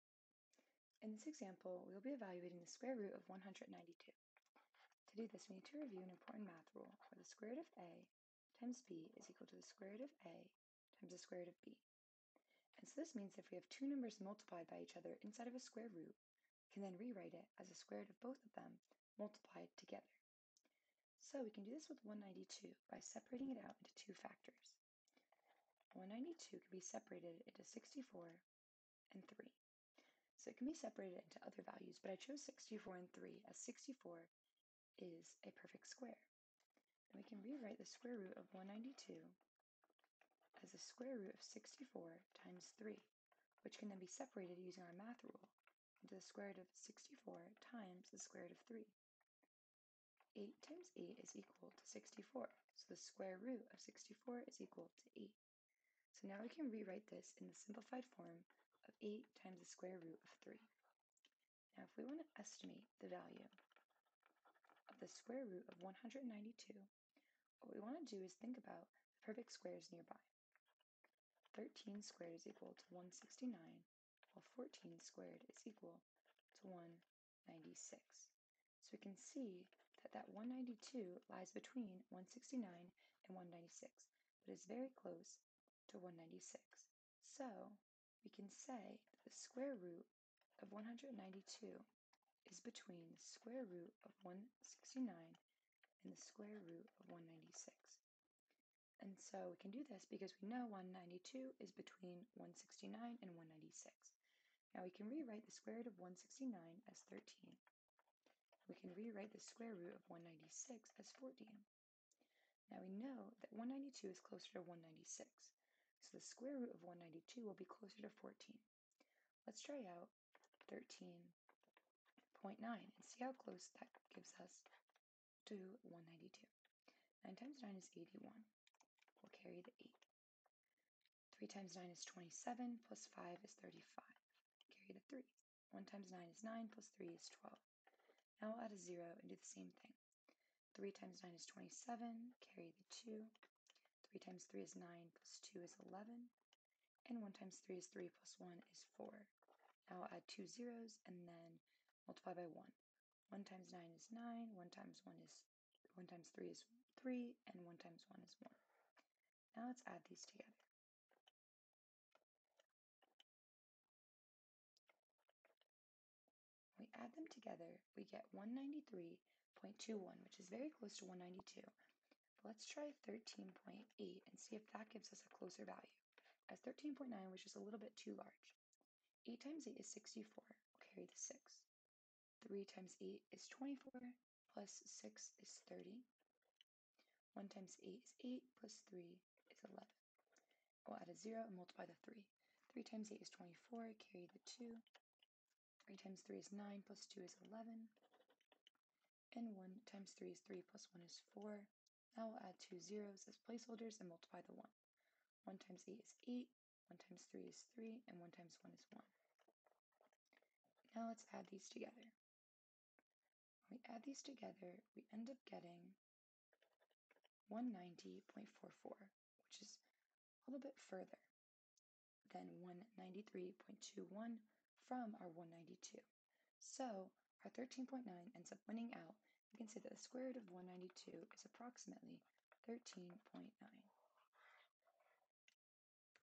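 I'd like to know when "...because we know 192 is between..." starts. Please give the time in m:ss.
1:40.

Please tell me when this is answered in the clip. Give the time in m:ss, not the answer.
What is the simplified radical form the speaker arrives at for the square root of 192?
0:59.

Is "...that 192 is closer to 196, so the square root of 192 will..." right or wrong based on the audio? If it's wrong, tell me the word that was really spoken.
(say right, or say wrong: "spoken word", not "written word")
right.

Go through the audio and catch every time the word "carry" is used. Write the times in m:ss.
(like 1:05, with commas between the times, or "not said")
2:09, 2:14, 2:22, 3:00, 3:14.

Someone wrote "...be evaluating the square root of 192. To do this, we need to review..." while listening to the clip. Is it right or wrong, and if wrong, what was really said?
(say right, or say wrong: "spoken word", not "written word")
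right.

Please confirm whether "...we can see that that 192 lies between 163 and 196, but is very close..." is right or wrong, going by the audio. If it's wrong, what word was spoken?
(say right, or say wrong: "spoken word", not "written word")
wrong: "169", not "163".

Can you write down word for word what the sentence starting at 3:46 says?
So our 13.9 ends up winning out we can say that the square root of 192 is approximately 13.9.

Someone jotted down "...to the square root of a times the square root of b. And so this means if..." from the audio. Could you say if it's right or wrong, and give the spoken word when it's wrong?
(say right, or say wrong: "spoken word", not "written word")
right.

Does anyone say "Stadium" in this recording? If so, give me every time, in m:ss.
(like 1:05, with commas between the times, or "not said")
not said.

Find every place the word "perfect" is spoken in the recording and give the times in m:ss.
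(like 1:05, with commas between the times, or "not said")
0:35, 1:09.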